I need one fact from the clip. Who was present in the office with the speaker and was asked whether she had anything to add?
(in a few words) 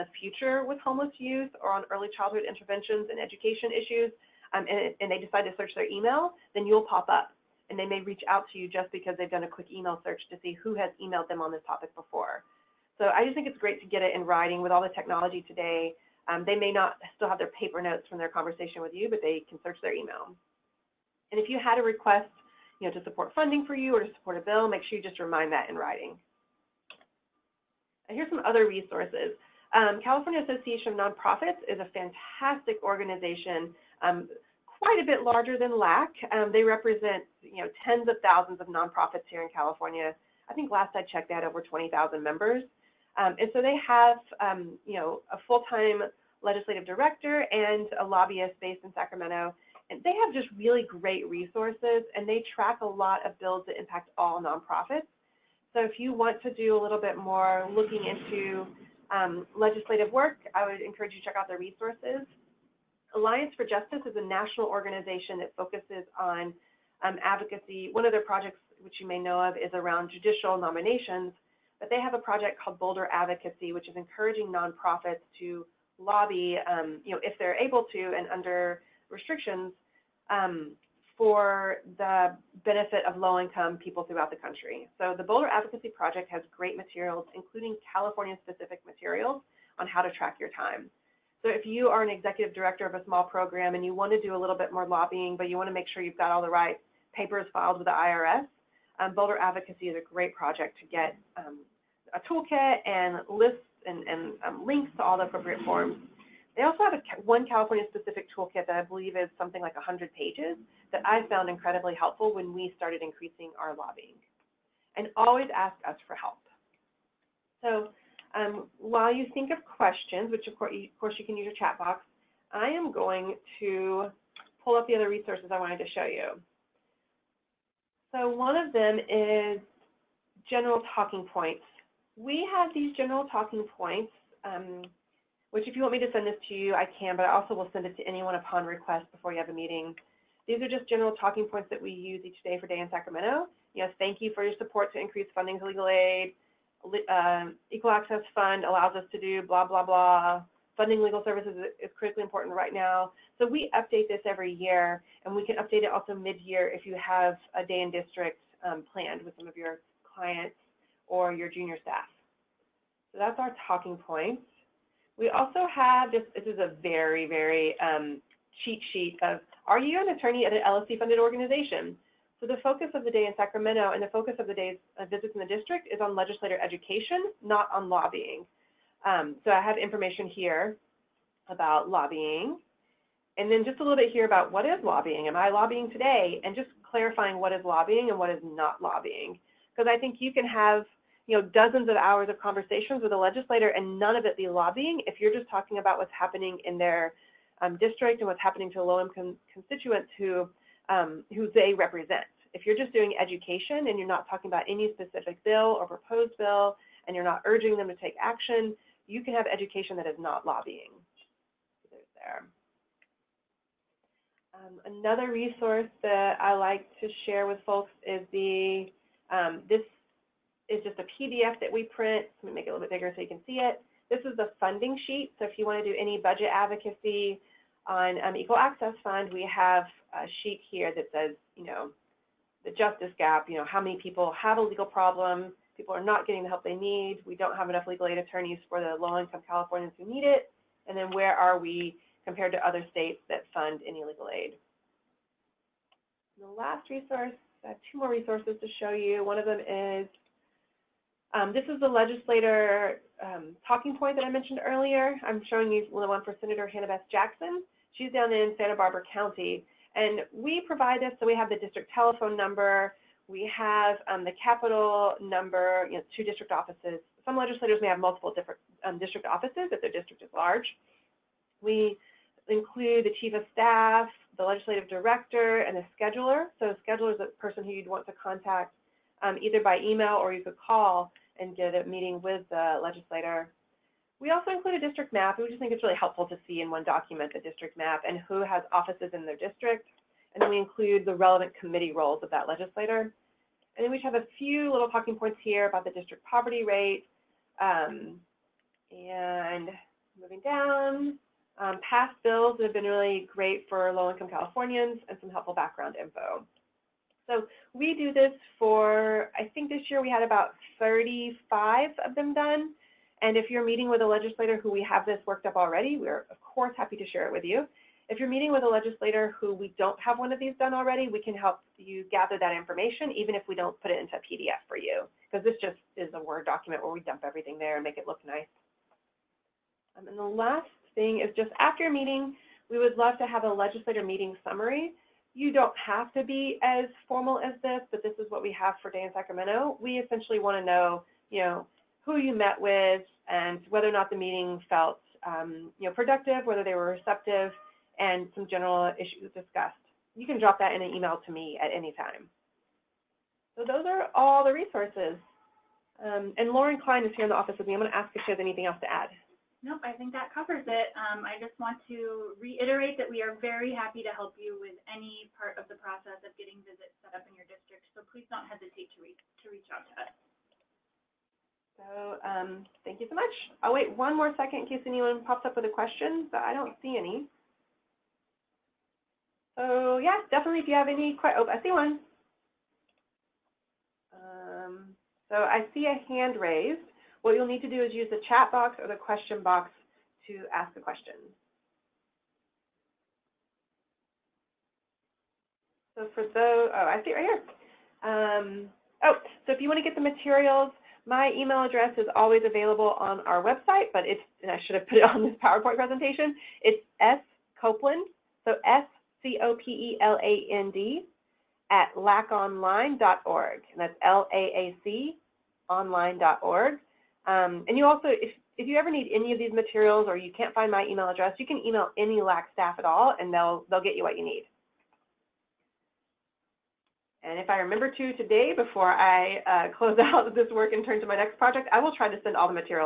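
Lauren Klein.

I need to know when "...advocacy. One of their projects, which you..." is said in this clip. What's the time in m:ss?
1:07.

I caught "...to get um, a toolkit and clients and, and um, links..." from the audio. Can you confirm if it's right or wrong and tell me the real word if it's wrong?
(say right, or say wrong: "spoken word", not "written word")
wrong: "lists", not "clients".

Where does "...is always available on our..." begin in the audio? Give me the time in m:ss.
6:41.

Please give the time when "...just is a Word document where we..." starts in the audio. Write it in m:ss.
5:25.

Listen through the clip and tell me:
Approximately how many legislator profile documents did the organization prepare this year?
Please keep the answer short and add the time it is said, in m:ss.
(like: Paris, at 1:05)
35, at 5:10.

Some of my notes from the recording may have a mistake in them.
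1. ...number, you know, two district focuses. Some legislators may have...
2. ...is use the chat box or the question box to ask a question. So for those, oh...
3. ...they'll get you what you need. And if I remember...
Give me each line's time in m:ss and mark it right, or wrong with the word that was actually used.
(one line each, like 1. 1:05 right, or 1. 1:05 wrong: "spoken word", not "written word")
1. 4:25 wrong: "offices", not "focuses"
2. 6:27 right
3. 7:03 right.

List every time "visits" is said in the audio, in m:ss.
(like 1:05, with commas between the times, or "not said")
2:55, 6:06.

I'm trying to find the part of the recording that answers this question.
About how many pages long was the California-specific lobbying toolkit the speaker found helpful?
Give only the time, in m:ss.
1:49.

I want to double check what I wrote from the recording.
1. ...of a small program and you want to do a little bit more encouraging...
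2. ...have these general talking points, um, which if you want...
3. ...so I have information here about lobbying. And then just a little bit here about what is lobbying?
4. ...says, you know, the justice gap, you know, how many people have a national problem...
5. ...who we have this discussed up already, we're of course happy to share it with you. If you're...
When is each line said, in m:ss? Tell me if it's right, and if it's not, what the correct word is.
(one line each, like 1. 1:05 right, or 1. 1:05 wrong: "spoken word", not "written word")
1. 1:32 wrong: "lobbying", not "encouraging"
2. 2:12 right
3. 2:59 right
4. 3:51 wrong: "legal", not "national"
5. 5:14 wrong: "worked", not "discussed".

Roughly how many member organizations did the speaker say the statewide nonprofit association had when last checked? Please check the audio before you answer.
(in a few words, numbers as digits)
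over 20,000.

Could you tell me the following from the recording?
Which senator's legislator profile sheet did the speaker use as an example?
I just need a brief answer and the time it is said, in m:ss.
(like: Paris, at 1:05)
Hannah Beth Jackson, at 4:16.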